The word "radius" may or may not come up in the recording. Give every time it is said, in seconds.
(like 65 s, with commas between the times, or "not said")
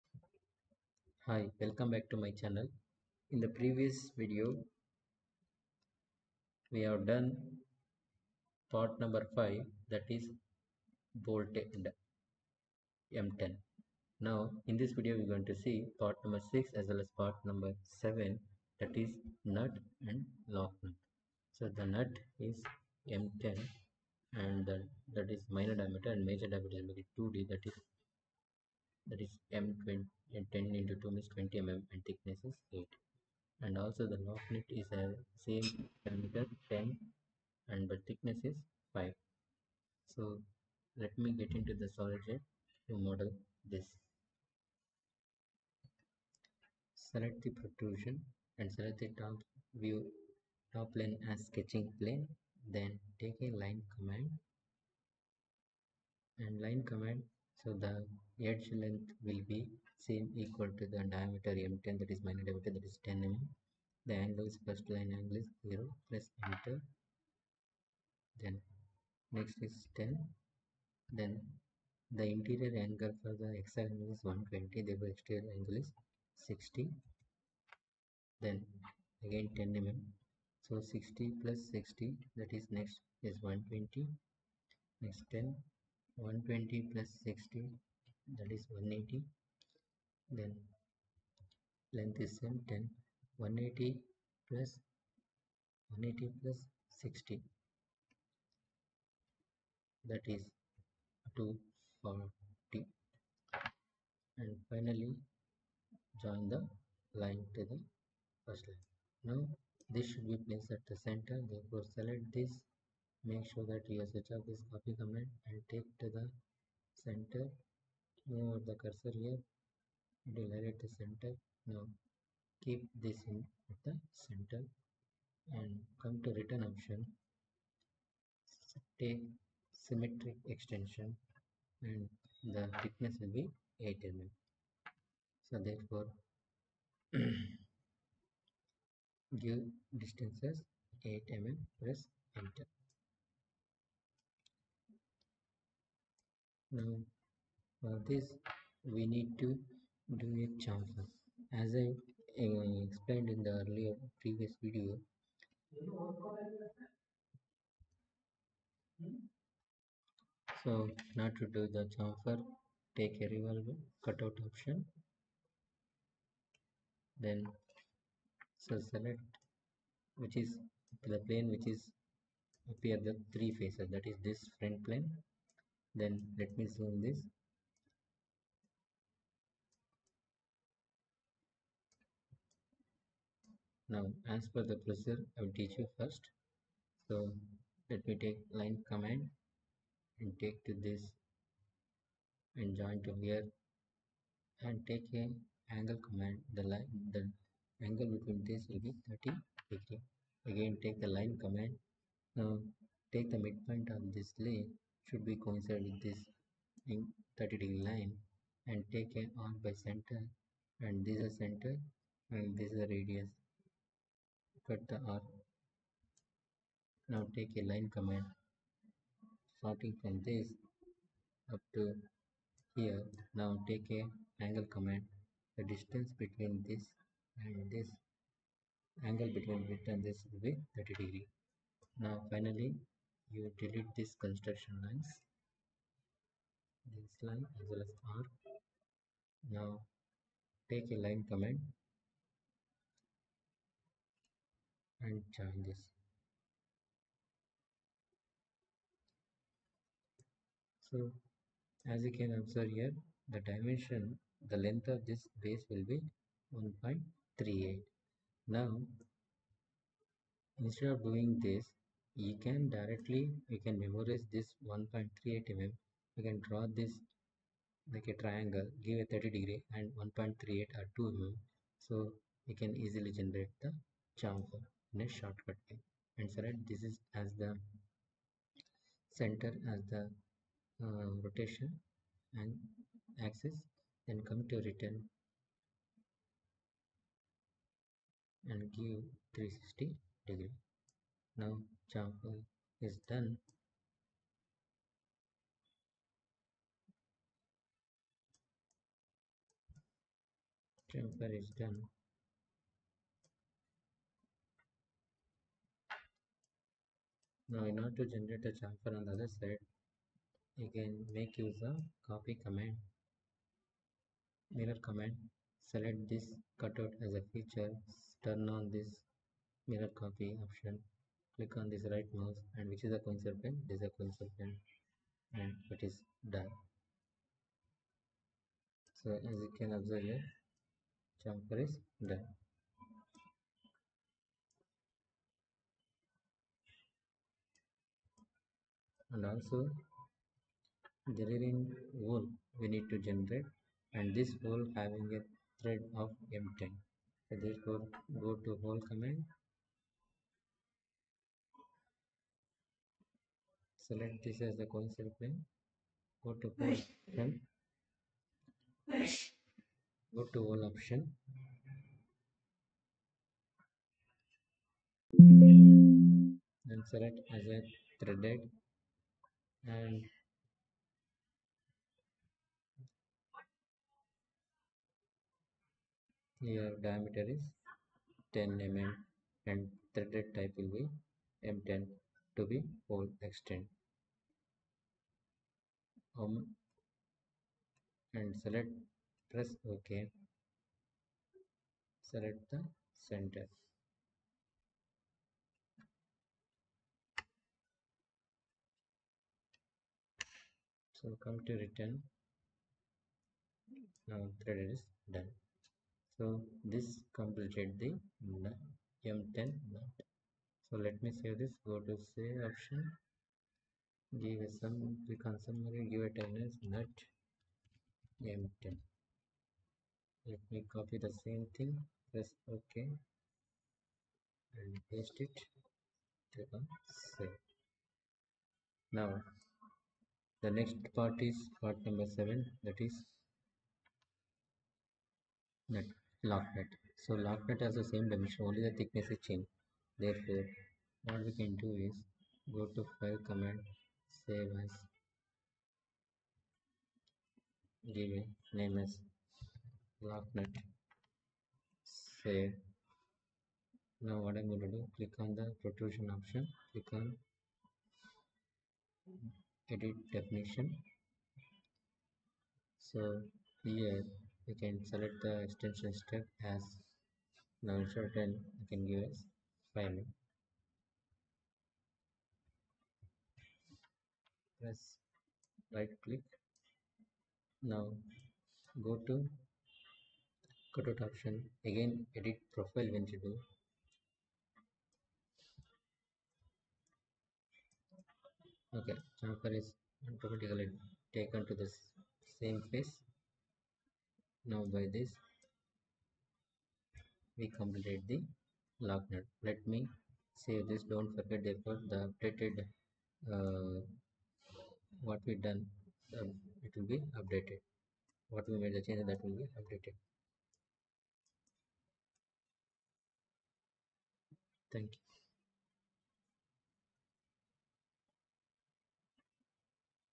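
212 s.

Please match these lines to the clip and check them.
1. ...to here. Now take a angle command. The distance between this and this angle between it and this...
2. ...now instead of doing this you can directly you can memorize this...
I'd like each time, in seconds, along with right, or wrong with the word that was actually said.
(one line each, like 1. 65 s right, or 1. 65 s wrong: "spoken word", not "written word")
1. 221 s right
2. 258 s right.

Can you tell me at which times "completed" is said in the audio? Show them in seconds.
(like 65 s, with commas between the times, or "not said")
407 s, 497 s.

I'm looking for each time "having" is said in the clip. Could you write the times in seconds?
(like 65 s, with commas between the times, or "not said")
344 s.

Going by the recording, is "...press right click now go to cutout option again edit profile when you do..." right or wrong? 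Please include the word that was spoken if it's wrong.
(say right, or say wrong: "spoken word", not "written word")
right.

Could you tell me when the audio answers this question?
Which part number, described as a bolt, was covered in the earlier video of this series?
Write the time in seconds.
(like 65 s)
8 s.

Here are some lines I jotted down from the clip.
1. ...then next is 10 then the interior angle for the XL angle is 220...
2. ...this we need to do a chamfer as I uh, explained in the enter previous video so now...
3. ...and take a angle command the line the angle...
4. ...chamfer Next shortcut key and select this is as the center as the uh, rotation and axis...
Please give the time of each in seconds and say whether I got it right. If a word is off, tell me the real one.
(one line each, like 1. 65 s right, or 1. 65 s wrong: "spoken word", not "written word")
1. 68 s wrong: "120", not "220"
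2. 148 s wrong: "earlier", not "enter"
3. 194 s right
4. 274 s right.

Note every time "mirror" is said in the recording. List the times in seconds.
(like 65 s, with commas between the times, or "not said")
314 s, 319 s.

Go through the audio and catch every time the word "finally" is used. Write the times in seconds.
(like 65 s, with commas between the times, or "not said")
104 s, 232 s.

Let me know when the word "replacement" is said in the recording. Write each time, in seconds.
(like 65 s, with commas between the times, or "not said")
not said.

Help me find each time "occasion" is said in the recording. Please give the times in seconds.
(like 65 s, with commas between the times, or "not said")
not said.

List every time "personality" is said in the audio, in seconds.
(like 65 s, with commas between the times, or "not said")
not said.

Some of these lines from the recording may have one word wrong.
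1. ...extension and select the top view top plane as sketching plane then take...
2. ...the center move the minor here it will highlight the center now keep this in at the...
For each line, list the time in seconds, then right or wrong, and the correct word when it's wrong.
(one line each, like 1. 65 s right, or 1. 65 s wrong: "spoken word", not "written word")
1. 47 s wrong: "protrusion", not "extension"
2. 116 s wrong: "cursor", not "minor".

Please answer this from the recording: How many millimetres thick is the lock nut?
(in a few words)
5.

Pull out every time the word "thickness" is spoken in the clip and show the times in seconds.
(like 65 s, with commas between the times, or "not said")
32 s, 38 s, 132 s, 438 s.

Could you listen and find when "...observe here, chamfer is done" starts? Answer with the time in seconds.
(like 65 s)
329 s.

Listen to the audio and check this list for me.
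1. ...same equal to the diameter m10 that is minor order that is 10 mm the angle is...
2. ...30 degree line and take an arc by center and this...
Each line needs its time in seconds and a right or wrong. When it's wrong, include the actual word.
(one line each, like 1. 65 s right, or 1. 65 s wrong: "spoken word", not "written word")
1. 60 s wrong: "diameter", not "order"
2. 206 s right.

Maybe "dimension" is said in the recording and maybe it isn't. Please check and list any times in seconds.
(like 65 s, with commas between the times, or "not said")
253 s, 438 s.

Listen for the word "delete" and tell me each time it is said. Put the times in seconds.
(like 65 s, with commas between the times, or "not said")
233 s.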